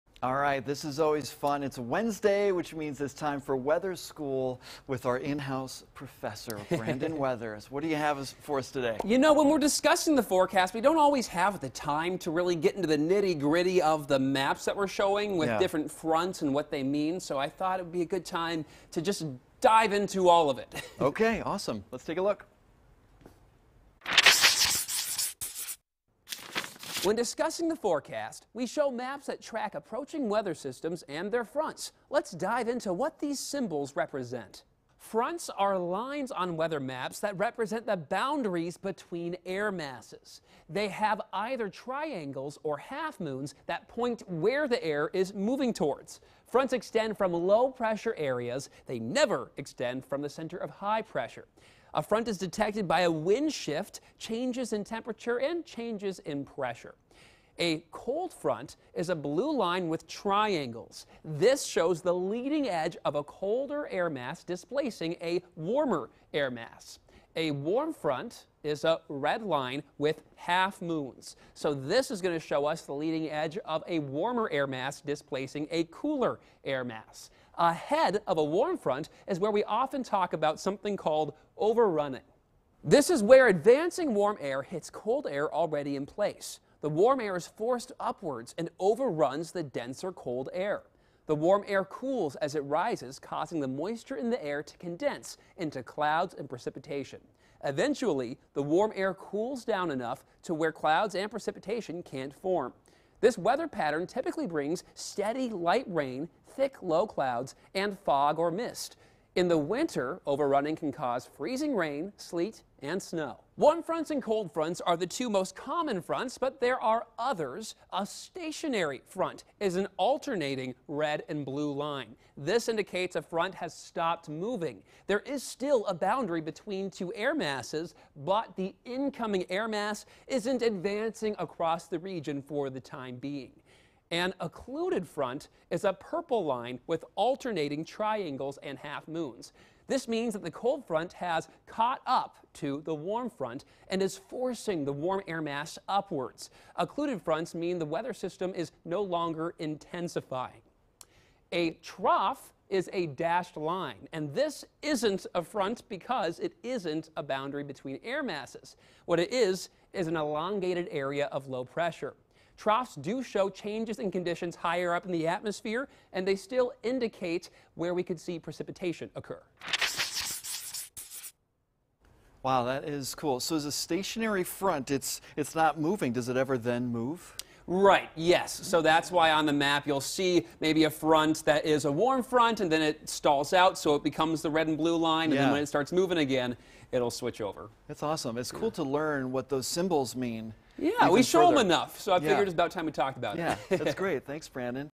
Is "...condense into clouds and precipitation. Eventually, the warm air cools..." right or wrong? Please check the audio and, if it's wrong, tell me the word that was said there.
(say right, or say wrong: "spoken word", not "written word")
right.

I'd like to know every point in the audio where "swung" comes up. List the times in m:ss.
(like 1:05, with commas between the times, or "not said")
not said.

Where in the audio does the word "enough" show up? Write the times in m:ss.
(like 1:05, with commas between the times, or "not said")
1:39, 3:11.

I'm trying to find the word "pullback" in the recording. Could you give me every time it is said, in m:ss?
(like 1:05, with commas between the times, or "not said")
not said.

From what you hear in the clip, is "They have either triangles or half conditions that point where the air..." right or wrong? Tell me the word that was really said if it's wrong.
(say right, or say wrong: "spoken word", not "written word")
wrong: "moons", not "conditions".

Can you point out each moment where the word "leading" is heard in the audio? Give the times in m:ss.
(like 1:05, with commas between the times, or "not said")
1:02, 1:12.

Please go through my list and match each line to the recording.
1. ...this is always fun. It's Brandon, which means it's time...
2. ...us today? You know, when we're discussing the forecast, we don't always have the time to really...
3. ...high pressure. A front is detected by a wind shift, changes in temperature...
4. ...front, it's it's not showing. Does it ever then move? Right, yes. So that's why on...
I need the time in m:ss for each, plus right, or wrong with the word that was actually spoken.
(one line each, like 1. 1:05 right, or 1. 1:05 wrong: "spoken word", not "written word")
1. 0:00 wrong: "Wednesday", not "Brandon"
2. 0:08 right
3. 0:50 right
4. 2:54 wrong: "moving", not "showing".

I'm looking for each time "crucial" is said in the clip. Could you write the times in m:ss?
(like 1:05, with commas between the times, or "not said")
not said.